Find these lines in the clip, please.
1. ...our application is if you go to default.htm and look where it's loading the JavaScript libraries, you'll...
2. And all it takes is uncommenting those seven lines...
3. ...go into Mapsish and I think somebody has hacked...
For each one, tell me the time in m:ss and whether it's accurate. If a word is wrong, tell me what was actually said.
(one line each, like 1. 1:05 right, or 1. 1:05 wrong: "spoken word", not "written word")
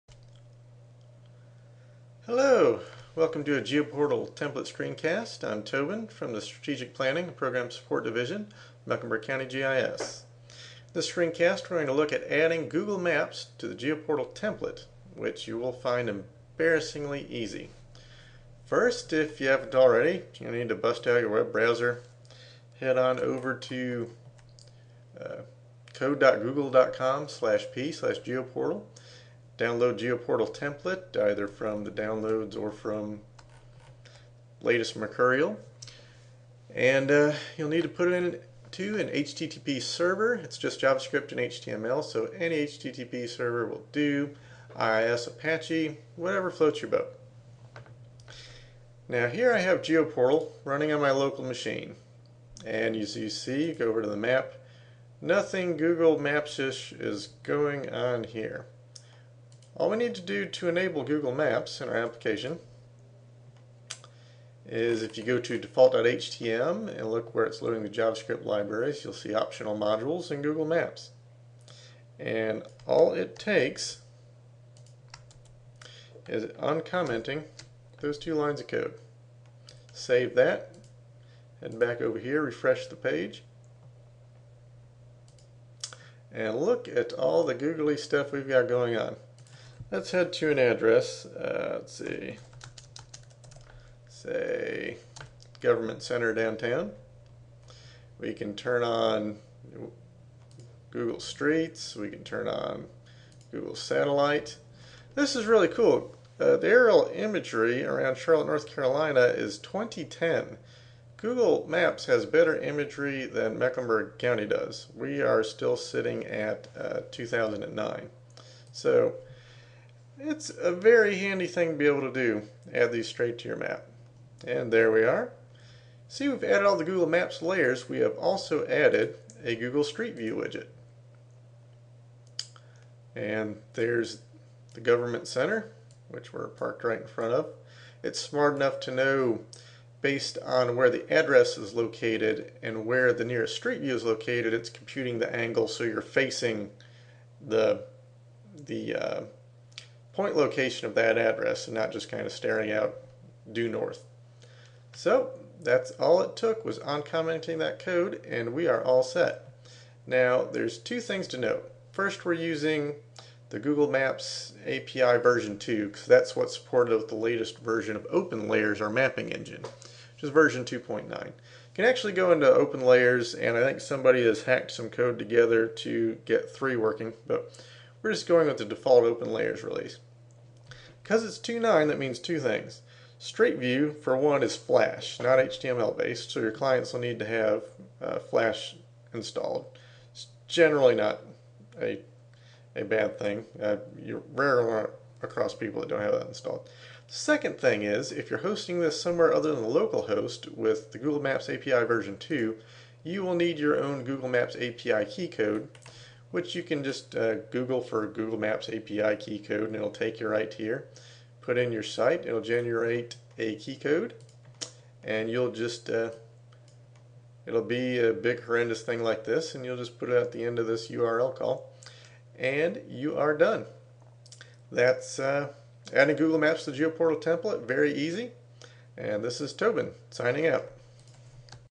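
1. 1:01 right
2. 1:12 wrong: "two", not "seven"
3. 2:52 wrong: "OpenLayers", not "Mapsish".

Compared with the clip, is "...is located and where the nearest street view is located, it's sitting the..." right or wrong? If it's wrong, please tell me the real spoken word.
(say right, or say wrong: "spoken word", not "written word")
wrong: "computing", not "sitting".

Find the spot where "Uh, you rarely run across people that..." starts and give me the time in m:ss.
3:13.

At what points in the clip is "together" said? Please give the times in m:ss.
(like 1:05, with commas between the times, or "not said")
2:55.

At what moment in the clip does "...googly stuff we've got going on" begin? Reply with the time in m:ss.
1:27.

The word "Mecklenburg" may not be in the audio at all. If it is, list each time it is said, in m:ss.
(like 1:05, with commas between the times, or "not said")
0:08, 1:53.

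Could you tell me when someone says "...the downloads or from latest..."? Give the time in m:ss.
0:31.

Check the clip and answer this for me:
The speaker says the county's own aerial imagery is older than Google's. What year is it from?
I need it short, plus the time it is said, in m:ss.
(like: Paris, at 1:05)
2009, at 1:57.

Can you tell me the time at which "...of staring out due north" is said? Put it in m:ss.
2:32.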